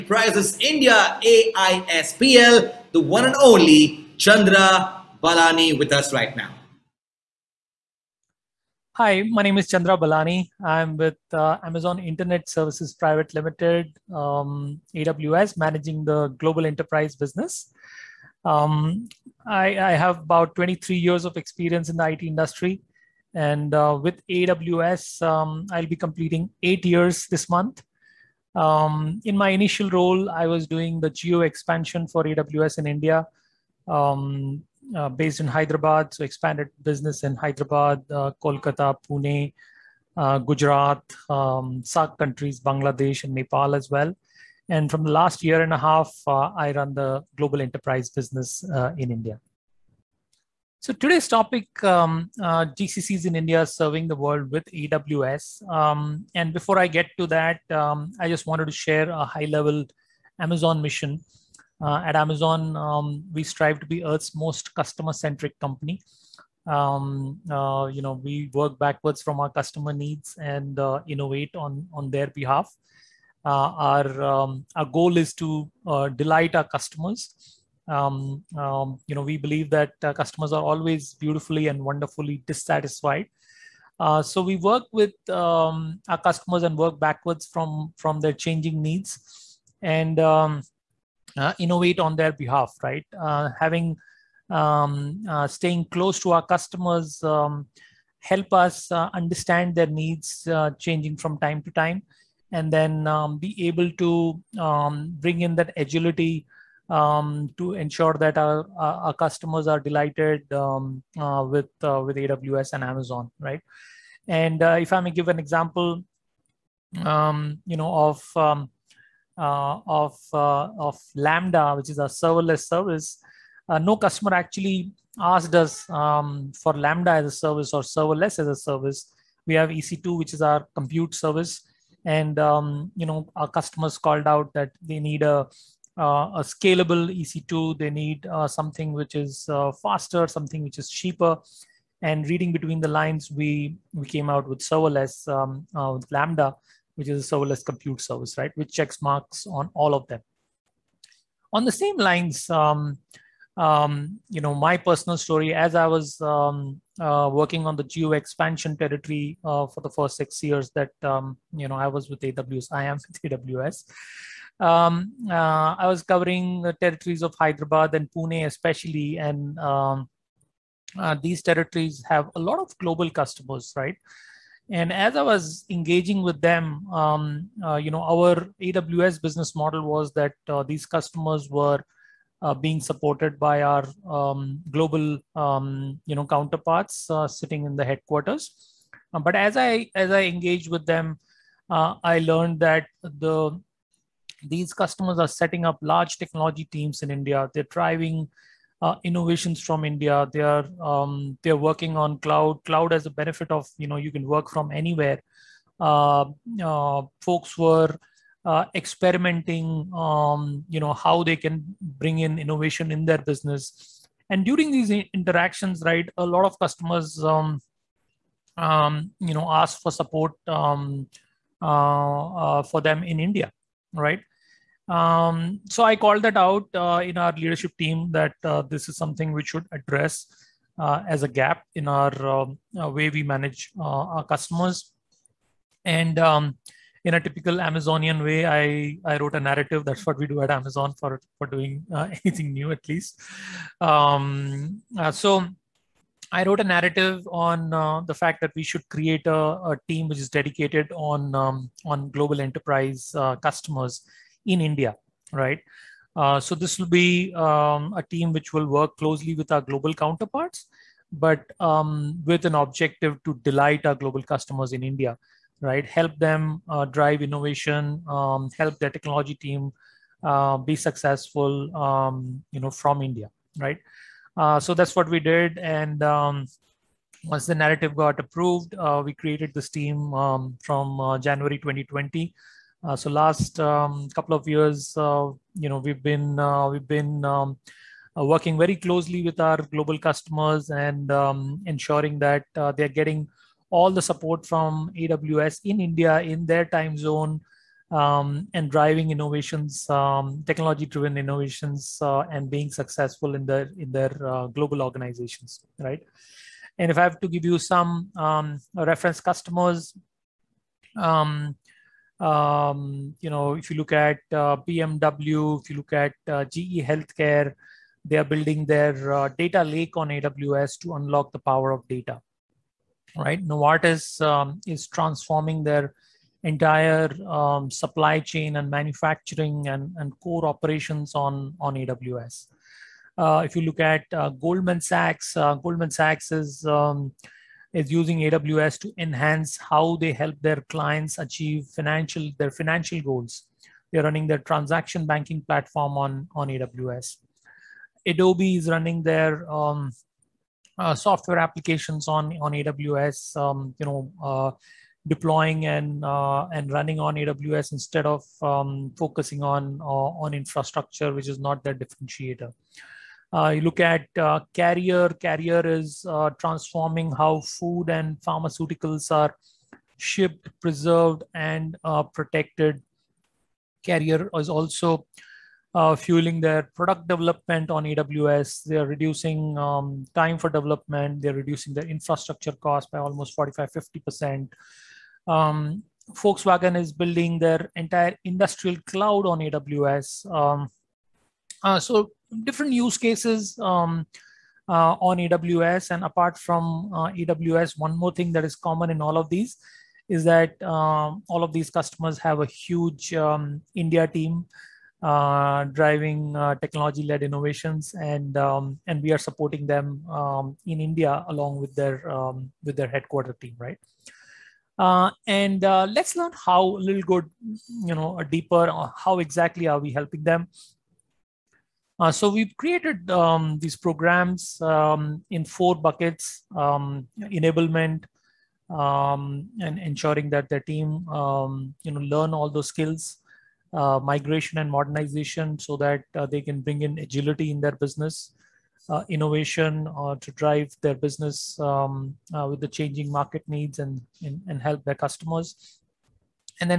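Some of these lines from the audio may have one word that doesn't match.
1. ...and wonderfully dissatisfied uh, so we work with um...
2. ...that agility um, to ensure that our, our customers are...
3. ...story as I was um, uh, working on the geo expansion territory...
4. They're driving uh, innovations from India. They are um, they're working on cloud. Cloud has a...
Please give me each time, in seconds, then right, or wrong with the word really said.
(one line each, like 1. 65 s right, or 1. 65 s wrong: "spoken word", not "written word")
1. 81 s right
2. 105 s right
3. 155 s right
4. 197 s right.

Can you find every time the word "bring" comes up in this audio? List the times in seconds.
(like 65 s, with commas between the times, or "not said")
105 s, 211 s, 436 s.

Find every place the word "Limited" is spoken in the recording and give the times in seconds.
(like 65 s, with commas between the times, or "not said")
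13 s.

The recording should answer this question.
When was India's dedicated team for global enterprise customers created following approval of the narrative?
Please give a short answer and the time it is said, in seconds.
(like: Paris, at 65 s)
January 2020, at 281 s.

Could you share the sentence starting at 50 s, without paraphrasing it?
So today's topic, um, uh, GCCs in India serving the world with AWS.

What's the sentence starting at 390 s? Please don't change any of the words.
Um, uh, so different use cases um, uh, on AWS.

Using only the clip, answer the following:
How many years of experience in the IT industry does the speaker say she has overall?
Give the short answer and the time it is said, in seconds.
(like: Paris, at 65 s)
23, at 20 s.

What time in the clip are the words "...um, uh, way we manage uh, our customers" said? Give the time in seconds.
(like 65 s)
232 s.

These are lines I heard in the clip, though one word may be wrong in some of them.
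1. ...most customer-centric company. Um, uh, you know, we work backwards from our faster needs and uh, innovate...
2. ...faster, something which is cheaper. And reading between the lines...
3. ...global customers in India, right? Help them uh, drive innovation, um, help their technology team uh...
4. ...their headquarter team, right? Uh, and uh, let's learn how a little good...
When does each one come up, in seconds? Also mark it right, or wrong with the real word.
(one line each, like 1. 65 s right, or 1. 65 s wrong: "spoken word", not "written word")
1. 64 s wrong: "customer", not "faster"
2. 139 s right
3. 263 s right
4. 412 s right.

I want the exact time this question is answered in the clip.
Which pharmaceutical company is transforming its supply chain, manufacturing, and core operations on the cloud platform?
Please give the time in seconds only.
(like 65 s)
323 s.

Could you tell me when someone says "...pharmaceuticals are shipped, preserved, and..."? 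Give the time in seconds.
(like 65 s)
368 s.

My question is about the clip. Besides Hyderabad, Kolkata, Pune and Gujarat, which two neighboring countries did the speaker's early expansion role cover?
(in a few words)
Bangladesh and Nepal.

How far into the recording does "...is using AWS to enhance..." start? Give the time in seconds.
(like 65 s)
337 s.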